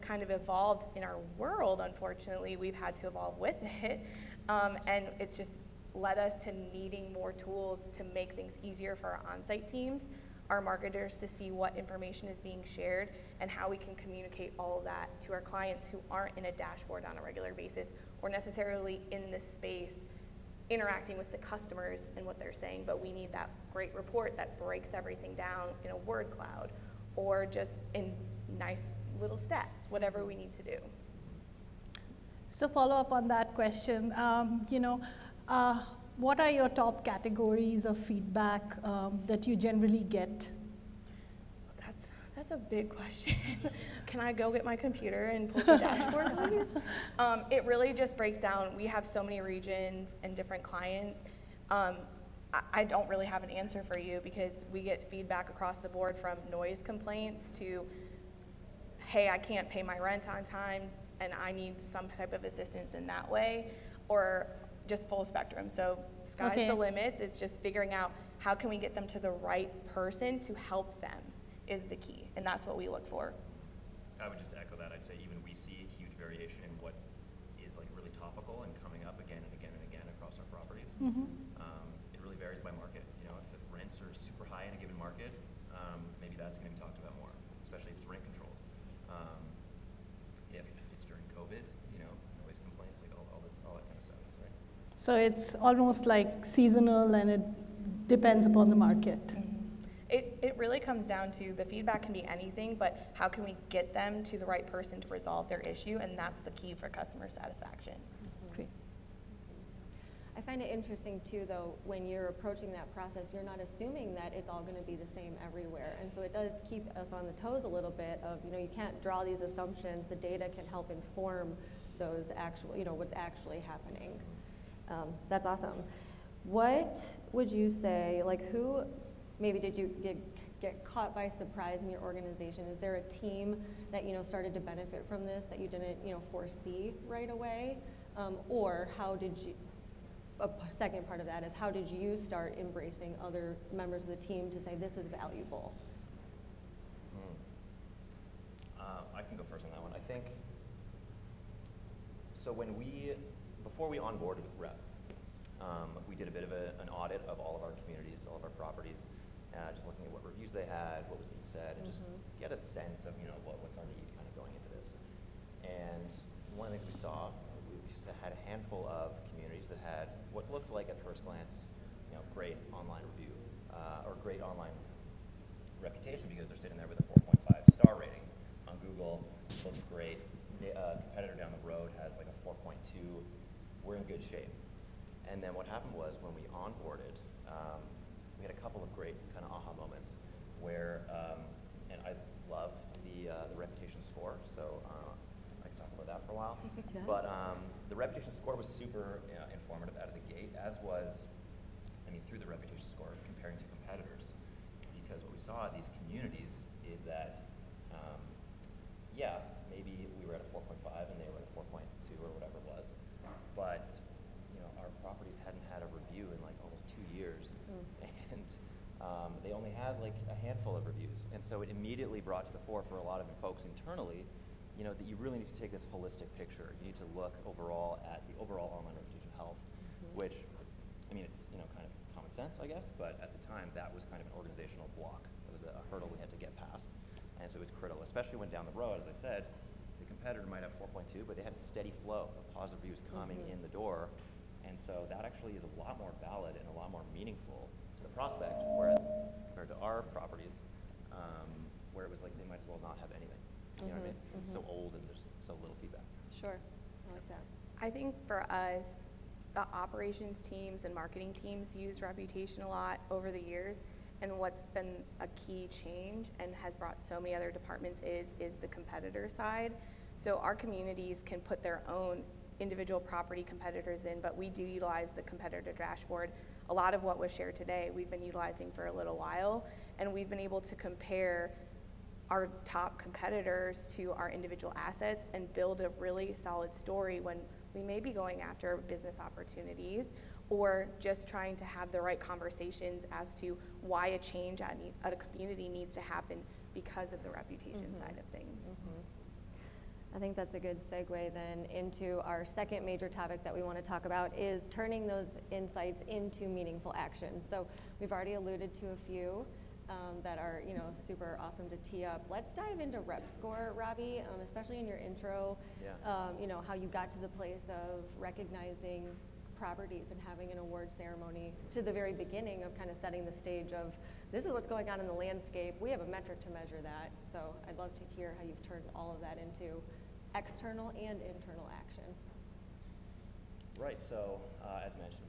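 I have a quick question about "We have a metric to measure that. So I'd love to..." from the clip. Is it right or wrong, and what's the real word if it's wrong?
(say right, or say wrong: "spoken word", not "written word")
right.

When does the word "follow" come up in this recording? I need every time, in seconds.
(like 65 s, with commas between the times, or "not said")
32 s.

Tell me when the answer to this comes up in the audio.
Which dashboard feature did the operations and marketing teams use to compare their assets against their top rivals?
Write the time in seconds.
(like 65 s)
275 s.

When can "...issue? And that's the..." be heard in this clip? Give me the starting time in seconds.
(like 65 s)
105 s.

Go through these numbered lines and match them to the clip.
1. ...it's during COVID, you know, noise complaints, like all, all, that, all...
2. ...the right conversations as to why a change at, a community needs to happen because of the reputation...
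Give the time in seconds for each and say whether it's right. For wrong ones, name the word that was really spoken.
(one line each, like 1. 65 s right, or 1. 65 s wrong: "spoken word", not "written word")
1. 90 s right
2. 291 s right.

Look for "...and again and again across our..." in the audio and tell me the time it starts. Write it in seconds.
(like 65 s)
79 s.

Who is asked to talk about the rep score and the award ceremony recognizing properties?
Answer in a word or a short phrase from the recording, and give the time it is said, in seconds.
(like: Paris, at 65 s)
Robbie, at 313 s.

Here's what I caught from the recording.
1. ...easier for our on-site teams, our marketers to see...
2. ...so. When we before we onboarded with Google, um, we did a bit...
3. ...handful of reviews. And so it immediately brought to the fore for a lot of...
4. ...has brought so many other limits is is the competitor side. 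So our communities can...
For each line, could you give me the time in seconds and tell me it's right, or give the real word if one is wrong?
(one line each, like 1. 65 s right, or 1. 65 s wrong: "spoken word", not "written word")
1. 8 s right
2. 152 s wrong: "Rep", not "Google"
3. 220 s right
4. 266 s wrong: "departments", not "limits".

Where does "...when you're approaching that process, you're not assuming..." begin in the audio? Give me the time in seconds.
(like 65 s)
111 s.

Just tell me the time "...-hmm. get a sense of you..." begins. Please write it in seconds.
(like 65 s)
162 s.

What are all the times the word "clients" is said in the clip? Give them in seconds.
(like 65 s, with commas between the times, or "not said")
15 s, 50 s.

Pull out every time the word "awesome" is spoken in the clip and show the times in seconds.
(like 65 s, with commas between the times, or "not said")
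125 s, 311 s.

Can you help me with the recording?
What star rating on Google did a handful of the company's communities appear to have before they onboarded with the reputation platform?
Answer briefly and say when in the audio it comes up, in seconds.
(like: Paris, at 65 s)
4.5, at 177 s.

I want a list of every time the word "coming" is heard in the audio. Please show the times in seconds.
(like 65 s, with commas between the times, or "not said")
78 s, 243 s.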